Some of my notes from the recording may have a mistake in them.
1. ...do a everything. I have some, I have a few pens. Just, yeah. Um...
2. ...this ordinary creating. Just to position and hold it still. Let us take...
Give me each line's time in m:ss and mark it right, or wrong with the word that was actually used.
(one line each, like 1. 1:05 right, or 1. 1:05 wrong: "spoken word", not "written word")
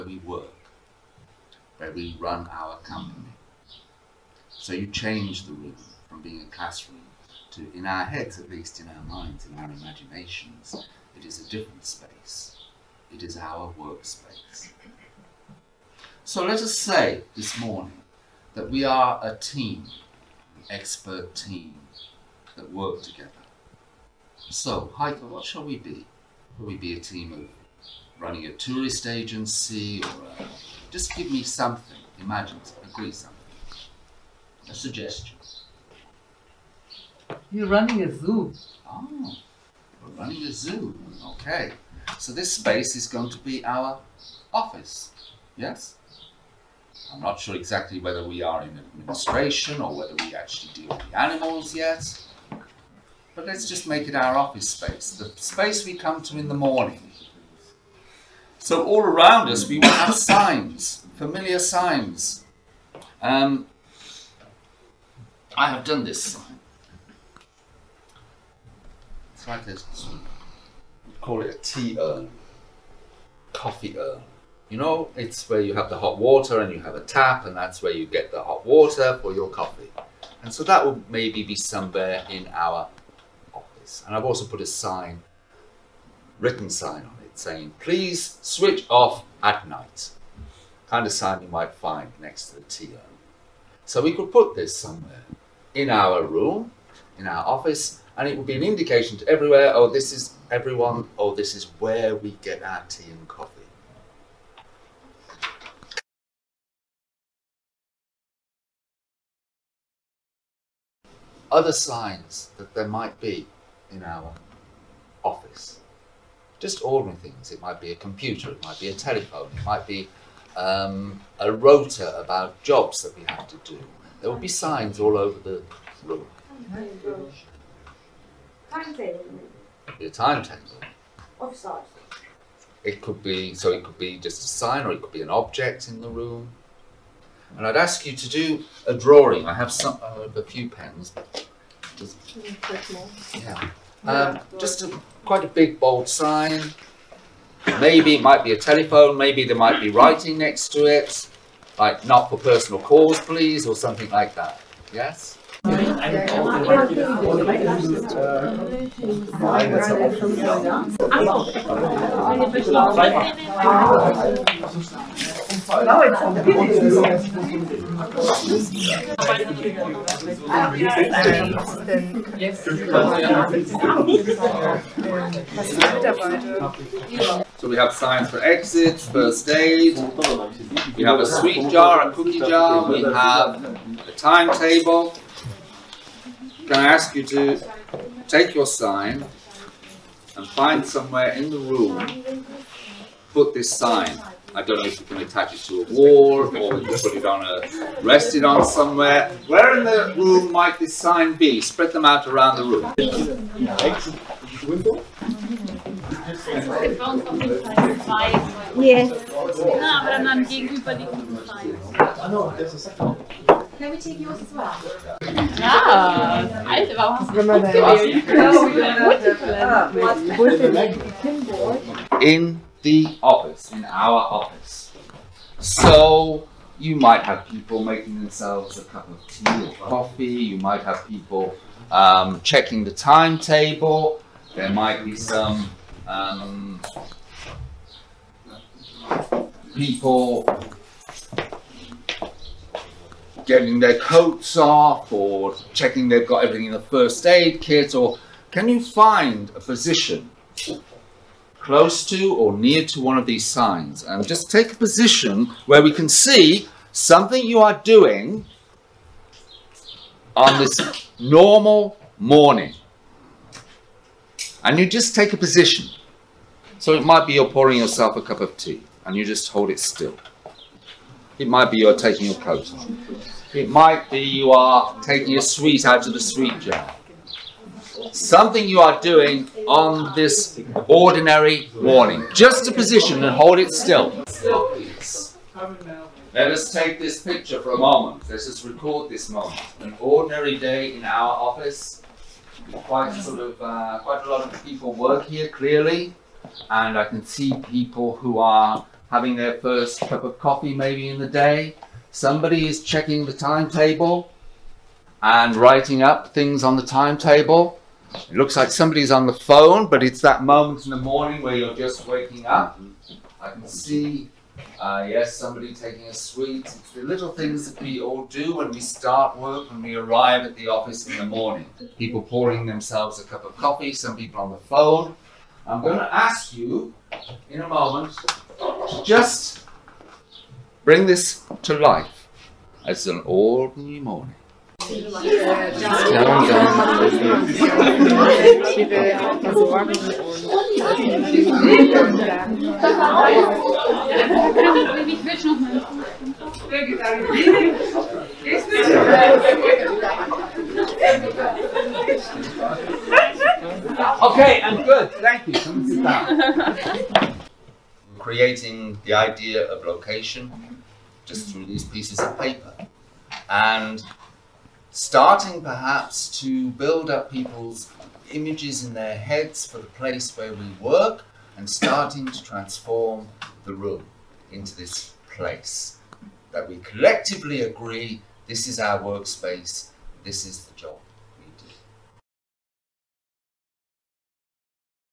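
1. 2:18 wrong: "drawing", not "everything"
2. 4:40 wrong: "morning", not "creating".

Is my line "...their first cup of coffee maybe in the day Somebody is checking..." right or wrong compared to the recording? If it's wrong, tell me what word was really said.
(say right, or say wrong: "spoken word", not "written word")
right.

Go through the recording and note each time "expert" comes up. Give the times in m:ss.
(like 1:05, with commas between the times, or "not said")
0:20.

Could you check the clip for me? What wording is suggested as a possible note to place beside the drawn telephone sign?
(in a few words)
Not for personal calls.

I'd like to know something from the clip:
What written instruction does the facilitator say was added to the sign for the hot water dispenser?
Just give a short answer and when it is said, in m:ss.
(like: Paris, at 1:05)
Please switch off at night, at 1:27.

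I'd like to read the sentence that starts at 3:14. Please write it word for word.
I don't know if you can attach it to a wall or you put it on a, rest it on somewhere.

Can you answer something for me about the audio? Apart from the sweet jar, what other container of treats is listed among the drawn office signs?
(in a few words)
A cookie jar.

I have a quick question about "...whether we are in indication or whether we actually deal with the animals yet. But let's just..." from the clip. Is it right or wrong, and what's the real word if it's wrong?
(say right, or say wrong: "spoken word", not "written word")
wrong: "administration", not "indication".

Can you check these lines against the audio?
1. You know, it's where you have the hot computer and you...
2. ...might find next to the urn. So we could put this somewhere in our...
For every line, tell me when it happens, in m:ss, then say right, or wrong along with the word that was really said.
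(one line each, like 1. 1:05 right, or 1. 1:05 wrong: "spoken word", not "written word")
1. 1:14 wrong: "water", not "computer"
2. 1:31 right.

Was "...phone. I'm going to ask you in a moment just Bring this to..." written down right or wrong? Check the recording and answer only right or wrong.
right.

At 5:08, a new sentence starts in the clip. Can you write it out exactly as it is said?
It looks like somebody's on the phone, but it's that moment in the morning where you're just waking up.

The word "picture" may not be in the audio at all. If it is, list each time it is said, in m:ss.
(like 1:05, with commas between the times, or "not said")
4:47.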